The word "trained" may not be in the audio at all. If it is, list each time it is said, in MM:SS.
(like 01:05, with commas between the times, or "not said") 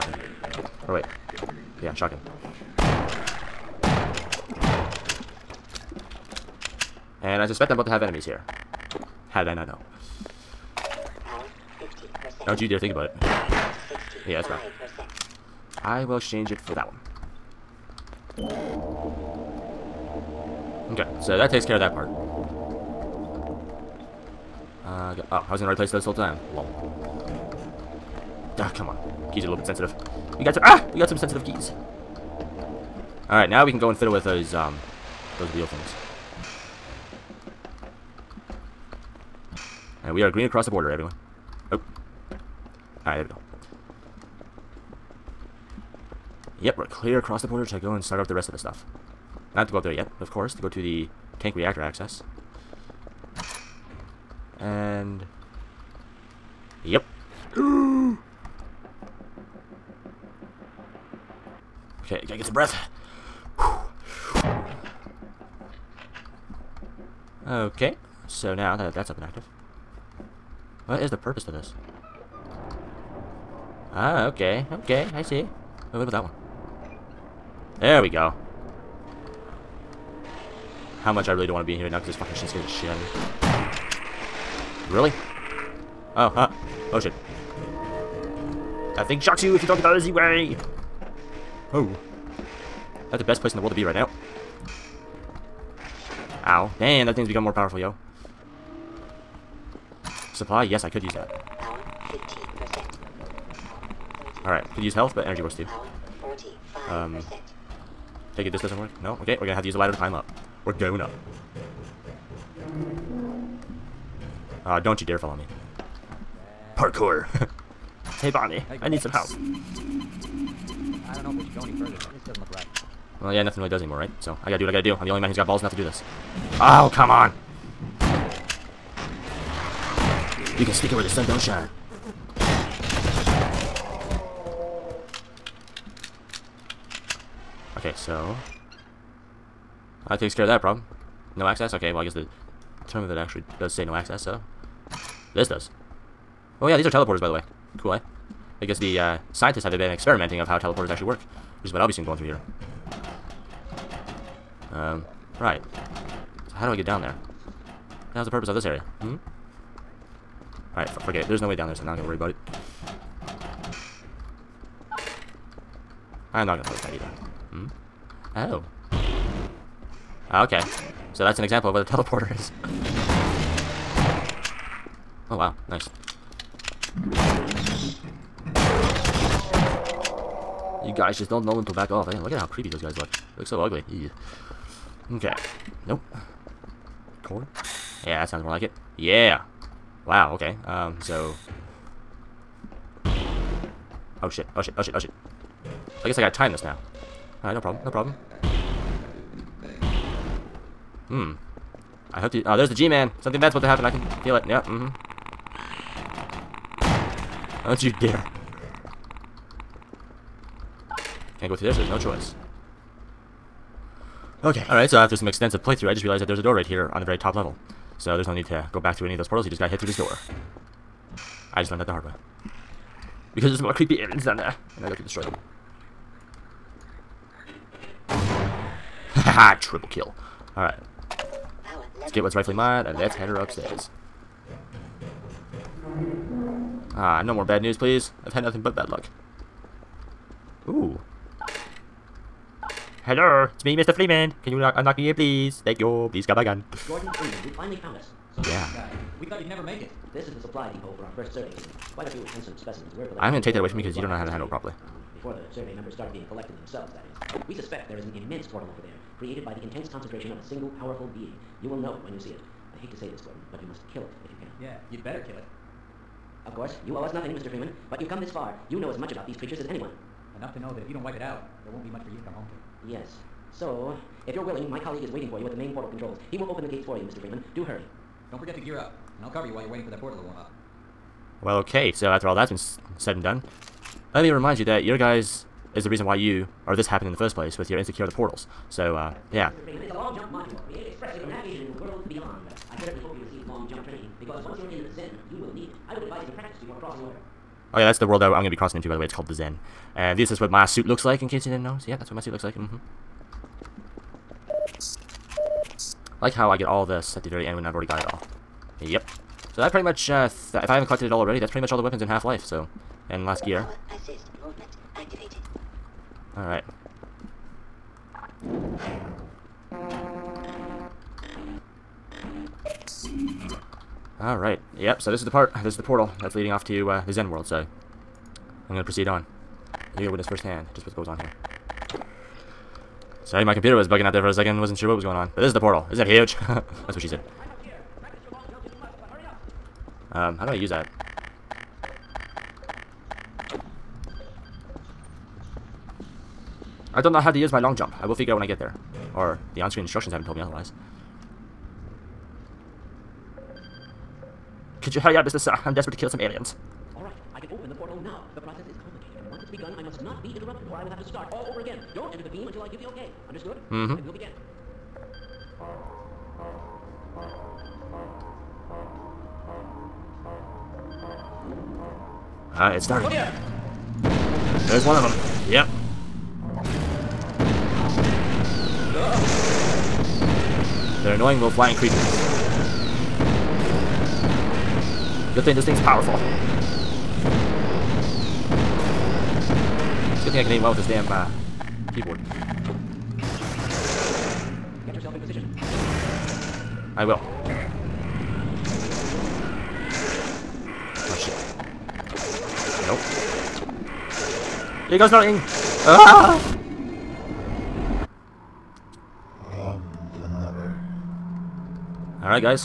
not said.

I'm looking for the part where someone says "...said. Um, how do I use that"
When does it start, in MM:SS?
05:37.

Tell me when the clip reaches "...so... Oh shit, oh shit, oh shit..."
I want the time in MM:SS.
03:11.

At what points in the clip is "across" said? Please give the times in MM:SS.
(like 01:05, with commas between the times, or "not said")
00:40, 00:47.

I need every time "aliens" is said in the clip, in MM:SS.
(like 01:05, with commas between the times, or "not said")
03:43, 05:56.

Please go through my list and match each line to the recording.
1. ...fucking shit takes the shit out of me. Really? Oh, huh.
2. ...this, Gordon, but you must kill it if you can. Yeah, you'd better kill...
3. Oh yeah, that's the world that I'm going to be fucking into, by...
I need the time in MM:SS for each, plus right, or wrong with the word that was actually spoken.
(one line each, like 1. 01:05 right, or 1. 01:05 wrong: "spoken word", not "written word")
1. 01:22 wrong: "scares", not "takes"
2. 04:23 right
3. 04:57 wrong: "crossing", not "fucking".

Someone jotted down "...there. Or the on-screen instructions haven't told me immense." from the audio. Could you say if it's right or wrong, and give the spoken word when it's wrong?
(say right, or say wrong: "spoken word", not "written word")
wrong: "otherwise", not "immense".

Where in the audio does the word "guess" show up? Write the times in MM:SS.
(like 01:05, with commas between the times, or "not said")
02:22, 02:28, 03:16.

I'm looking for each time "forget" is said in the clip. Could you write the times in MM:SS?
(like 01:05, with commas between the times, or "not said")
02:40, 04:38.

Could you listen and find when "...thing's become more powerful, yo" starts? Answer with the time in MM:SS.
01:37.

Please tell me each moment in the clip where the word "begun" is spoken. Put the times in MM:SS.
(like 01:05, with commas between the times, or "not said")
05:59.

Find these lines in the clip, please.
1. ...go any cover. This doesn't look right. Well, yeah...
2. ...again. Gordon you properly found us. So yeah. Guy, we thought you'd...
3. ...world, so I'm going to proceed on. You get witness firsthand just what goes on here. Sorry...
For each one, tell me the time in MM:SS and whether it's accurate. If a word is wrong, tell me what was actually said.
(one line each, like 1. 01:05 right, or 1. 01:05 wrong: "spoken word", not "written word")
1. 02:01 wrong: "further", not "cover"
2. 04:06 wrong: "finally", not "properly"
3. 05:27 right.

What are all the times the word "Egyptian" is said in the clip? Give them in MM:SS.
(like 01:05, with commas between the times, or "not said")
not said.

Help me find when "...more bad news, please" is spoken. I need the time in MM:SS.
03:57.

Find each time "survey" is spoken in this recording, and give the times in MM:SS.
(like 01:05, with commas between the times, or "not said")
04:11, 04:15.